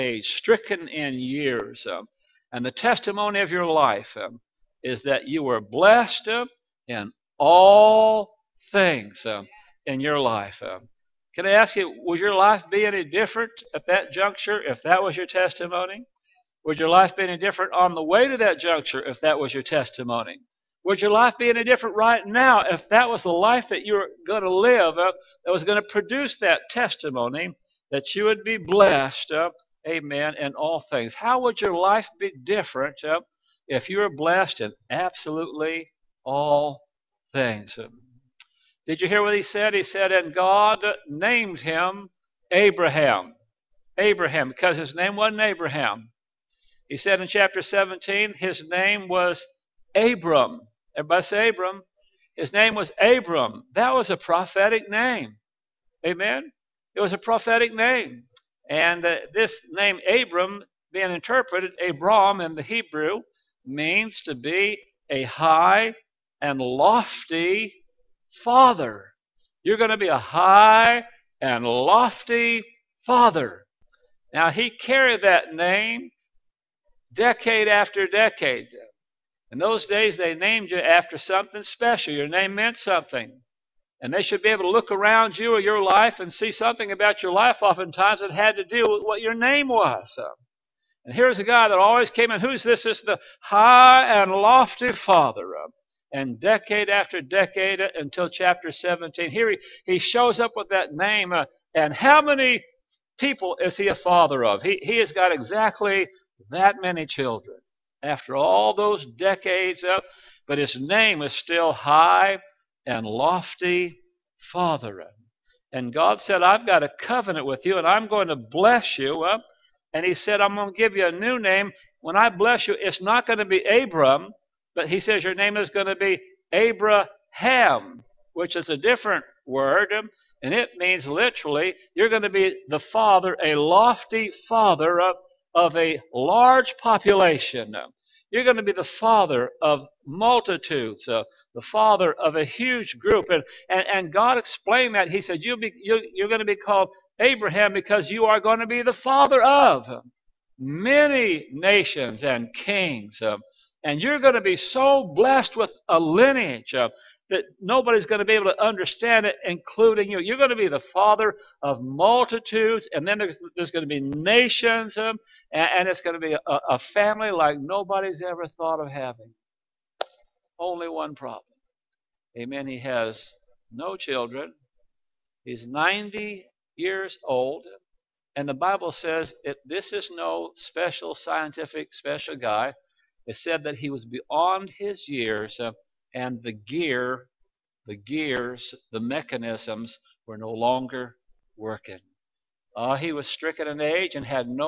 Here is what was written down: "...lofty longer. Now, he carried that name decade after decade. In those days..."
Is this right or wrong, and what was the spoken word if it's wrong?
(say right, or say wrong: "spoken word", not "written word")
wrong: "father", not "longer".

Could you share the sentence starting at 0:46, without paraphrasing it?
He said in chapter 17, his name was Abram.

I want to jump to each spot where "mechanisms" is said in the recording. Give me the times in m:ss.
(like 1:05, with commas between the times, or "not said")
3:09.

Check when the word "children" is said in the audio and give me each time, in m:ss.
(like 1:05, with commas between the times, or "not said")
1:47, 2:53.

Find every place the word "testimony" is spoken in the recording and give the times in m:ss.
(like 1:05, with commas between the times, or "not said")
0:02, 0:15, 0:19, 0:26.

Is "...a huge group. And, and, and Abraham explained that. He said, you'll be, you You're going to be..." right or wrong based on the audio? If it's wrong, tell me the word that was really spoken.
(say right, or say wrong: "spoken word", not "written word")
wrong: "God", not "Abraham".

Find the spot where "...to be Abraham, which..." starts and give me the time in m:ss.
2:05.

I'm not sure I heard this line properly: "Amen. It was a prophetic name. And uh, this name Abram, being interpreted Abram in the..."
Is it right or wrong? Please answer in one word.
right.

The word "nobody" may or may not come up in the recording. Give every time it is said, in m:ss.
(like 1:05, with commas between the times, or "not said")
2:37, 2:47.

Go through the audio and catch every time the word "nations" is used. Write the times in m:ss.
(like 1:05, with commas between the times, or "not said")
2:31, 2:44.